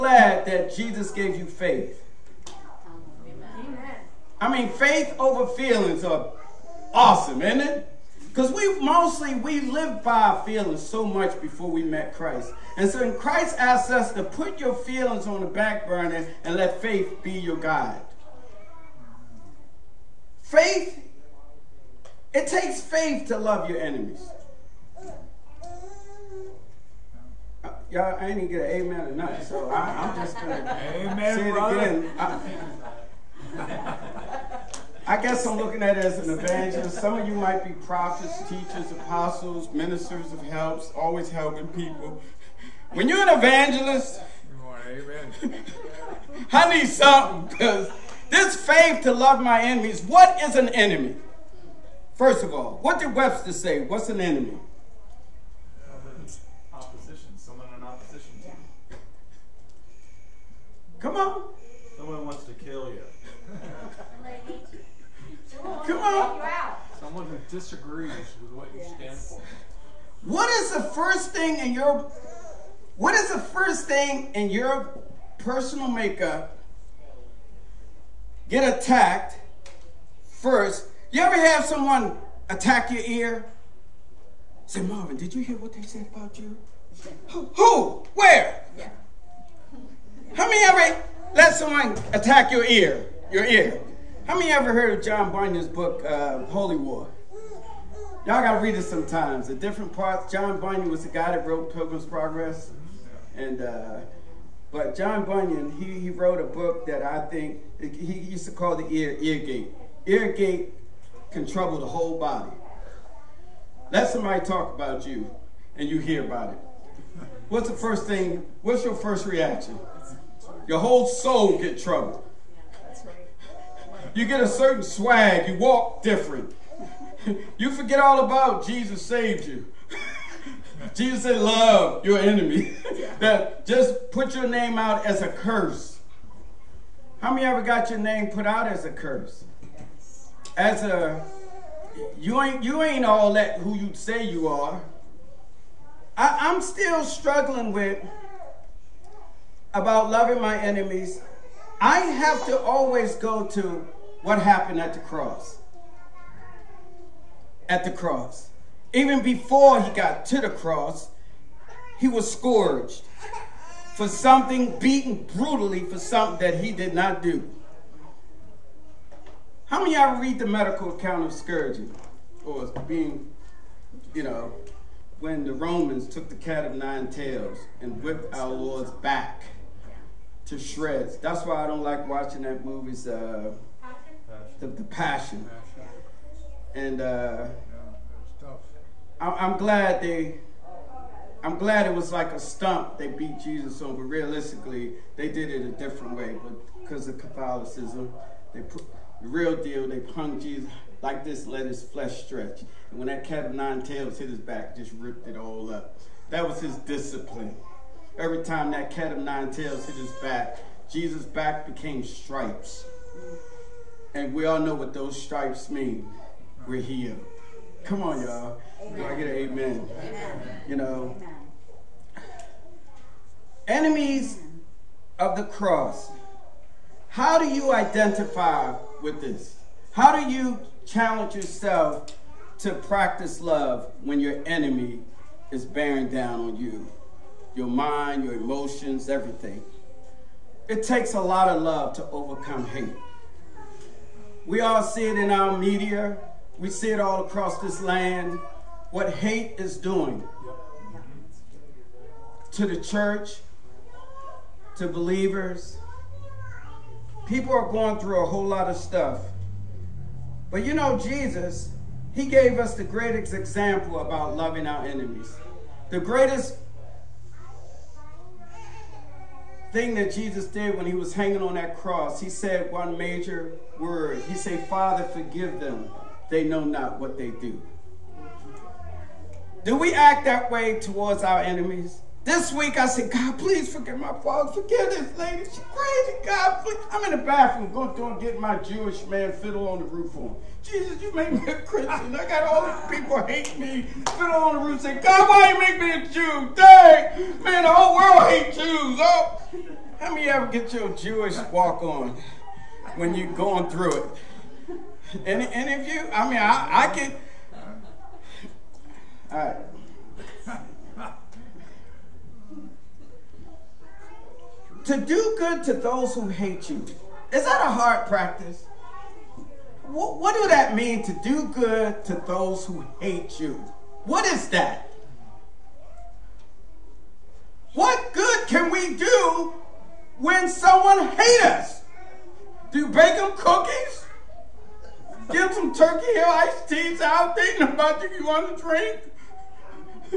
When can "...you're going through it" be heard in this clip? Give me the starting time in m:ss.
5:03.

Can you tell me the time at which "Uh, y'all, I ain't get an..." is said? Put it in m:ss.
0:27.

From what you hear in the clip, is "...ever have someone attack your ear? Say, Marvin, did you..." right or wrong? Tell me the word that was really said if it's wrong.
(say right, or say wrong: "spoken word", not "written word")
right.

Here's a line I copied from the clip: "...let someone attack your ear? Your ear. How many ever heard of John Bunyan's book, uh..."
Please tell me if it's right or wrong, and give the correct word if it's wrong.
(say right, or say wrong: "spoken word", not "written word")
right.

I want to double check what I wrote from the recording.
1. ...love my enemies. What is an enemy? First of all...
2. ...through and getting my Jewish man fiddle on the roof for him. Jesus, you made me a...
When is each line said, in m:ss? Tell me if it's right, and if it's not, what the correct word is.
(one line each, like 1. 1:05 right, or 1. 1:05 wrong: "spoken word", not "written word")
1. 0:49 right
2. 4:47 right.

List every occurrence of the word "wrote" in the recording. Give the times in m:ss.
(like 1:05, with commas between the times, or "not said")
1:41, 1:46.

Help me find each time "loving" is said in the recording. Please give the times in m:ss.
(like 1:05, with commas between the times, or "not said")
2:30, 4:24.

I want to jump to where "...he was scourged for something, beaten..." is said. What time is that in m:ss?
2:41.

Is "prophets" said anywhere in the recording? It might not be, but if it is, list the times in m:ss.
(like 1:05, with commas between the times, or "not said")
0:37.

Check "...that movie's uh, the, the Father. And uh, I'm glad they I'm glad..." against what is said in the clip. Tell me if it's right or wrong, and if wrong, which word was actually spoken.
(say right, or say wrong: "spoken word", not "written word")
wrong: "Passion", not "Father".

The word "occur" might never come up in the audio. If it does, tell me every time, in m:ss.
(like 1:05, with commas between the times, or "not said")
not said.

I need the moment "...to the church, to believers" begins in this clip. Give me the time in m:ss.
4:12.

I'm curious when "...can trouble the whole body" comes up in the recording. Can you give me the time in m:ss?
1:51.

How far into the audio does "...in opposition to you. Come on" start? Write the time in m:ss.
0:57.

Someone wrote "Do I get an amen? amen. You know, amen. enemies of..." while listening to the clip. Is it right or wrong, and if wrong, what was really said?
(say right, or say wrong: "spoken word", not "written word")
right.